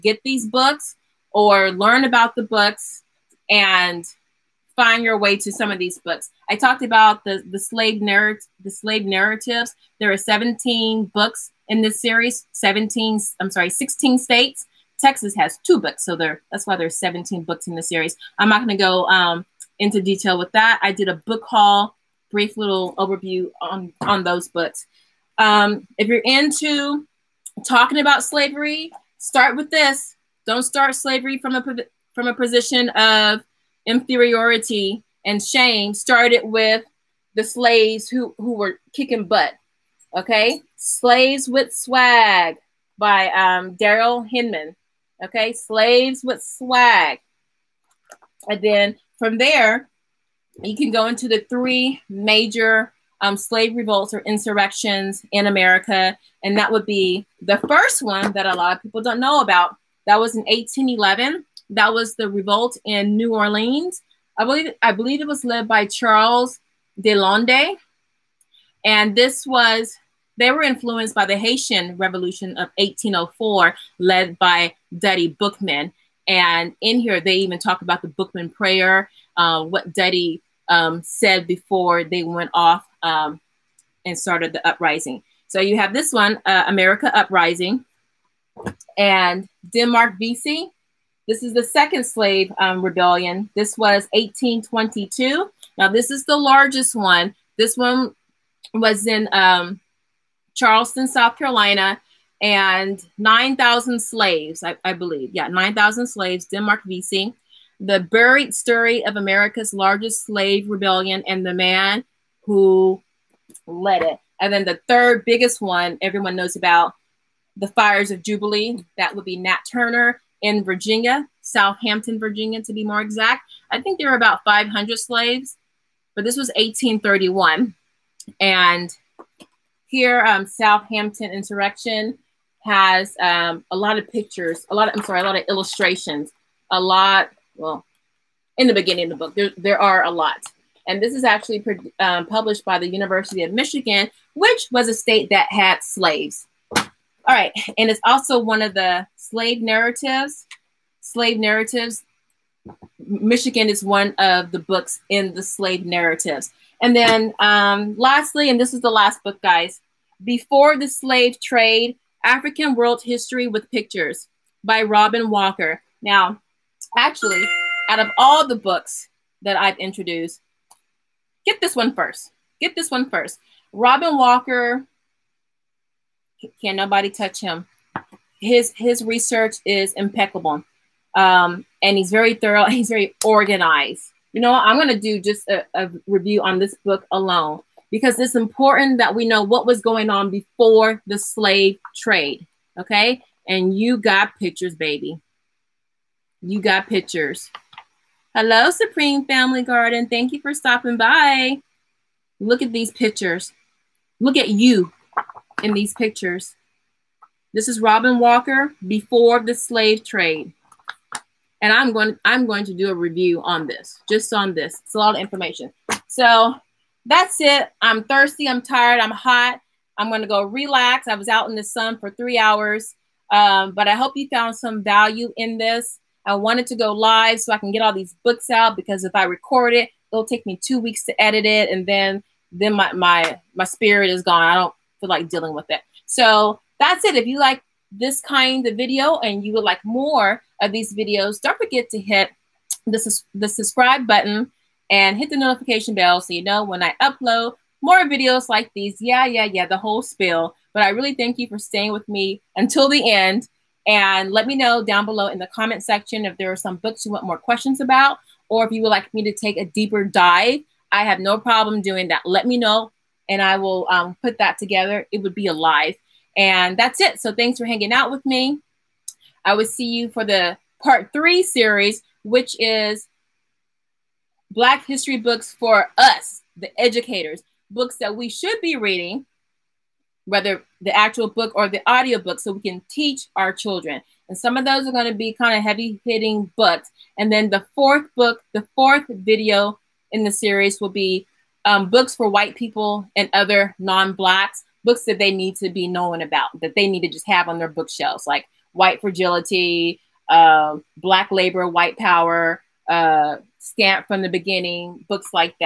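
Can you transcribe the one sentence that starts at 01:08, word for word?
And this was, they were influenced by the Haitian Revolution of 1804, led by Dutty Boukman.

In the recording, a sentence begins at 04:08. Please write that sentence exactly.
Yeah, yeah, yeah, the whole spiel.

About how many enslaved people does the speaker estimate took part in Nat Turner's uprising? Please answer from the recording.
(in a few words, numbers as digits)
500.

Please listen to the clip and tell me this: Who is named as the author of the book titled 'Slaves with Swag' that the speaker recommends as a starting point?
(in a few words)
Daryl Hinman.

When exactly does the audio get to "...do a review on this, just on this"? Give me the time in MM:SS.
03:32.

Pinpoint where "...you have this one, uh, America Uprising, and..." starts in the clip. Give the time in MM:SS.
01:25.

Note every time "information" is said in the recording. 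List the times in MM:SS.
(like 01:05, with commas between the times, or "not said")
03:35.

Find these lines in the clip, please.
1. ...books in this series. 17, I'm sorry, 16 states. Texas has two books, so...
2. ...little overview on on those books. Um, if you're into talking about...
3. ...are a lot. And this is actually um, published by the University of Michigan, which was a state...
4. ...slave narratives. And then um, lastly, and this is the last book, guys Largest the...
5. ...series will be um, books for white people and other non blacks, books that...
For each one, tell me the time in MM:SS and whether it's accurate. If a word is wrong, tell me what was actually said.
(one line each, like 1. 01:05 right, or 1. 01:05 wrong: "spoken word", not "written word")
1. 00:11 right
2. 00:22 right
3. 02:19 right
4. 02:35 wrong: "Before", not "Largest"
5. 04:50 right.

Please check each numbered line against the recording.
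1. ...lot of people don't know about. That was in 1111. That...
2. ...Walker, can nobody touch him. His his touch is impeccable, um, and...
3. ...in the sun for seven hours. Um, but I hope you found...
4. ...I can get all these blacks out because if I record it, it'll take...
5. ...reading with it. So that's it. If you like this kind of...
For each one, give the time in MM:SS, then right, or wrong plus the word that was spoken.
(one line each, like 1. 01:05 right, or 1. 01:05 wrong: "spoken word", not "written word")
1. 00:58 wrong: "1811", not "1111"
2. 02:54 wrong: "research", not "touch"
3. 03:41 wrong: "three", not "seven"
4. 03:47 wrong: "books", not "blacks"
5. 03:55 wrong: "dealing", not "reading".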